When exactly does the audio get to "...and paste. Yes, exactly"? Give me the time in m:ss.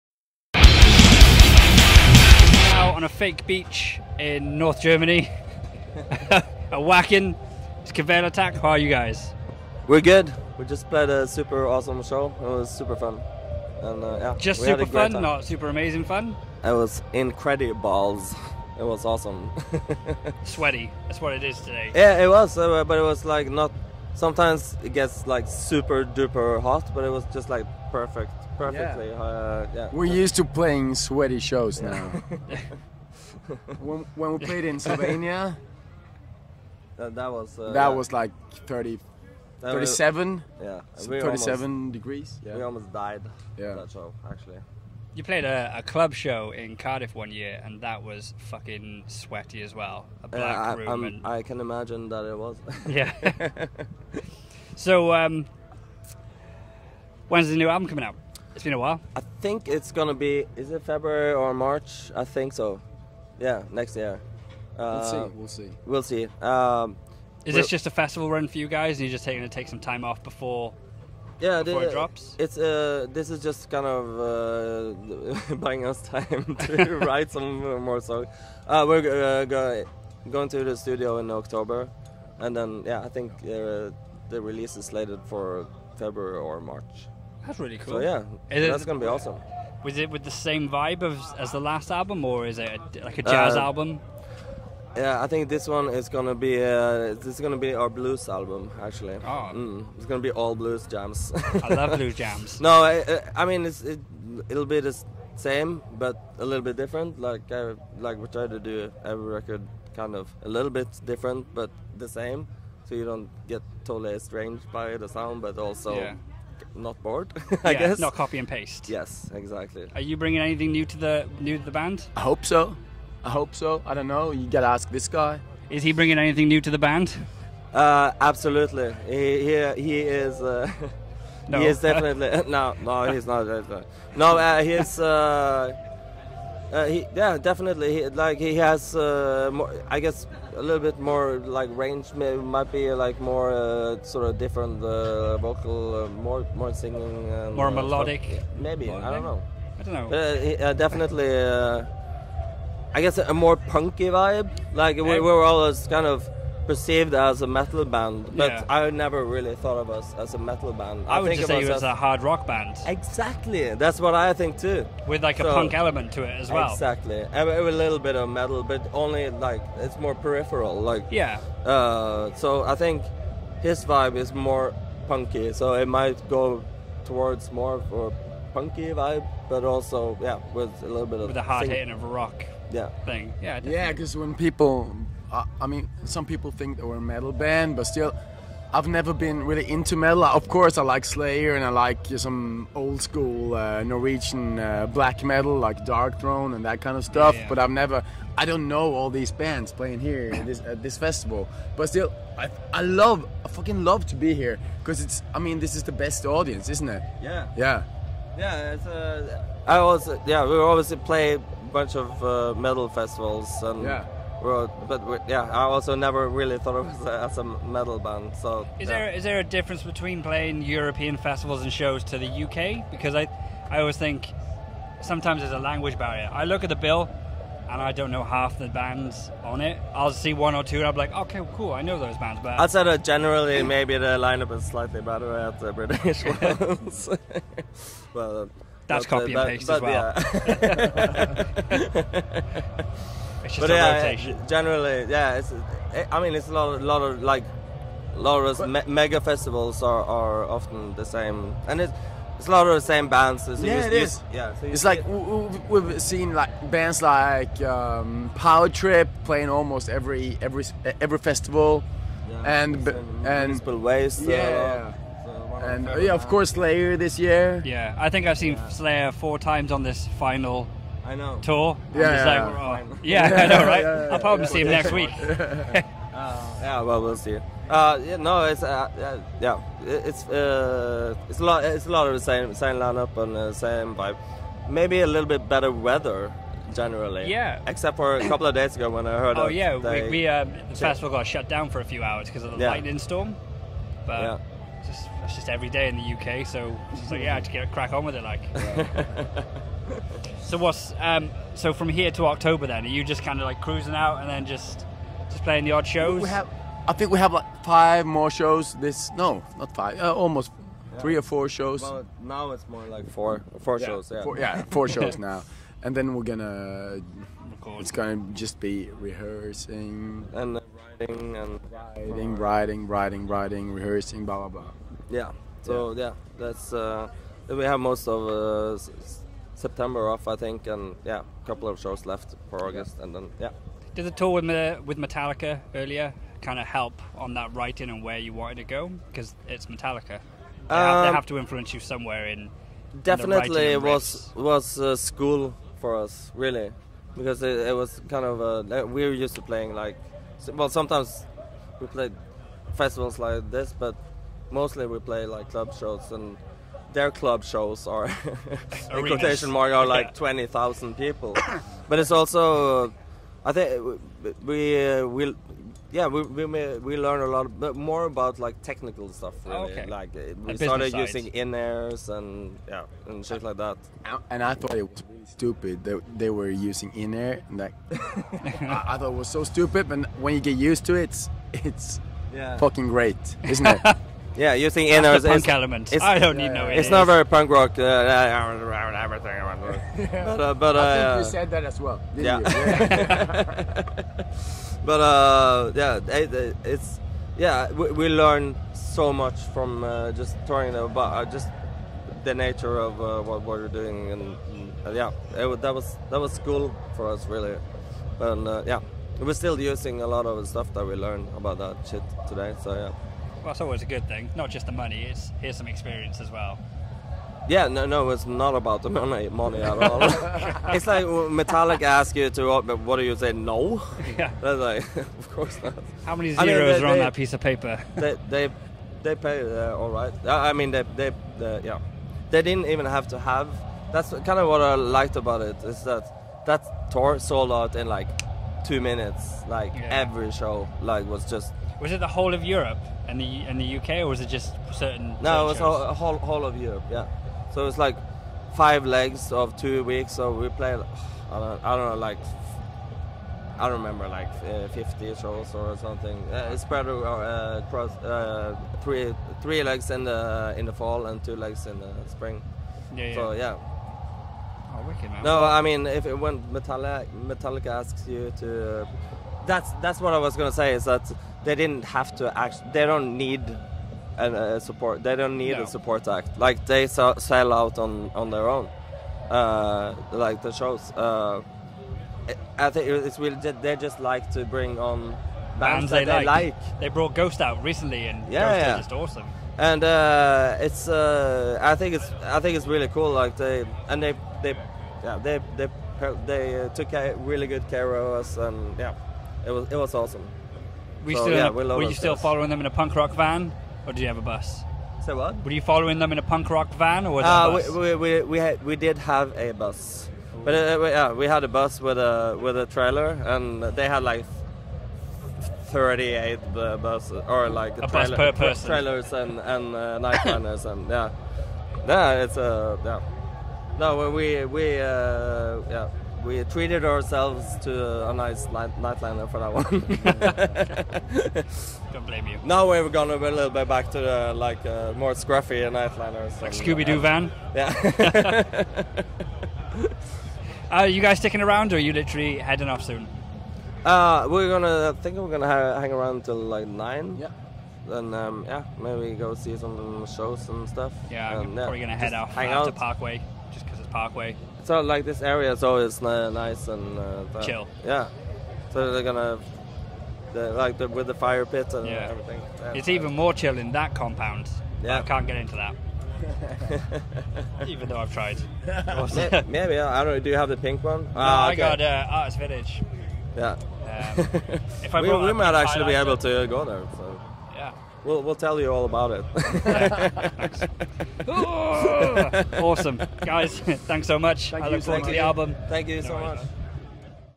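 1:58.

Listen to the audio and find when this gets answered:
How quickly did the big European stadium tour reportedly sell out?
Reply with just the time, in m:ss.
7:18.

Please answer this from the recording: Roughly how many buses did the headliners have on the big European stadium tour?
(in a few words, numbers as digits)
38.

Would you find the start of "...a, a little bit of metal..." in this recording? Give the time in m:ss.
2:47.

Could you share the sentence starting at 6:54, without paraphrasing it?
Not just the money; it's here's some experience as well.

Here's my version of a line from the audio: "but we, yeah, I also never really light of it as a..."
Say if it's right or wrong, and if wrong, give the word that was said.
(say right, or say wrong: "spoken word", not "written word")
wrong: "thought", not "light".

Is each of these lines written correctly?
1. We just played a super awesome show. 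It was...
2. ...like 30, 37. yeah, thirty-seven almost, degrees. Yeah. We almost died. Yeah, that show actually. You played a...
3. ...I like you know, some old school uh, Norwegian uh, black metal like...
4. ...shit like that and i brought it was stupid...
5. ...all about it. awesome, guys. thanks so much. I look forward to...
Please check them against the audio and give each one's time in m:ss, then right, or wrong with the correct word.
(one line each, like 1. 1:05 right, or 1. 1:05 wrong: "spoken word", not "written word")
1. 0:10 right
2. 0:38 right
3. 3:11 right
4. 6:13 wrong: "thought", not "brought"
5. 9:38 right.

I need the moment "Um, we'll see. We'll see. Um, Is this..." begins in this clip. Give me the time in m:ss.
1:05.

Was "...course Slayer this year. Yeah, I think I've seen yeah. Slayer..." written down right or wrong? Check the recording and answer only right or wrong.
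right.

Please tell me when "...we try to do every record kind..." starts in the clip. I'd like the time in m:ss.
1:48.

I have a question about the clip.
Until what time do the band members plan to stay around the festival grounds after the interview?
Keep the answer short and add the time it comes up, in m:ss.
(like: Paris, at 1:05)
9, at 9:06.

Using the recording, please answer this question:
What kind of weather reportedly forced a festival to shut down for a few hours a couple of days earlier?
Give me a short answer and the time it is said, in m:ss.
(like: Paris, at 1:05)
Lightning storm, at 4:52.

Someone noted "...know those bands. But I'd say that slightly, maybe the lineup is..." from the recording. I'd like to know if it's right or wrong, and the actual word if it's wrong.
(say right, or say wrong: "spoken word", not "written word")
wrong: "generally", not "slightly".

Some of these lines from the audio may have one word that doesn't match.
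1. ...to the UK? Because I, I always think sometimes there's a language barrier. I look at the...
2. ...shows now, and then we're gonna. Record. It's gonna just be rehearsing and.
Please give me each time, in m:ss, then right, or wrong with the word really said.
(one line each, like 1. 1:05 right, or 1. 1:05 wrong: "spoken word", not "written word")
1. 3:42 right
2. 5:14 right.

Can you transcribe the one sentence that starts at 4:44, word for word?
Maybe a little bit better weather generally.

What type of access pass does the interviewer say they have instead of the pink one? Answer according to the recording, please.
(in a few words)
Artist Village.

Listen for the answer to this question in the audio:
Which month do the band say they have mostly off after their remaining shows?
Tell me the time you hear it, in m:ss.
5:29.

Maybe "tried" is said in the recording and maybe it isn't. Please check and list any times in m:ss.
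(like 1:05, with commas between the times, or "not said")
9:28.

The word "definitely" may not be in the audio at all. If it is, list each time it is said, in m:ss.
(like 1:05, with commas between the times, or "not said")
2:11, 2:17, 2:30, 3:03, 5:43.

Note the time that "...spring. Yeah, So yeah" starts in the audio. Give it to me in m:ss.
7:42.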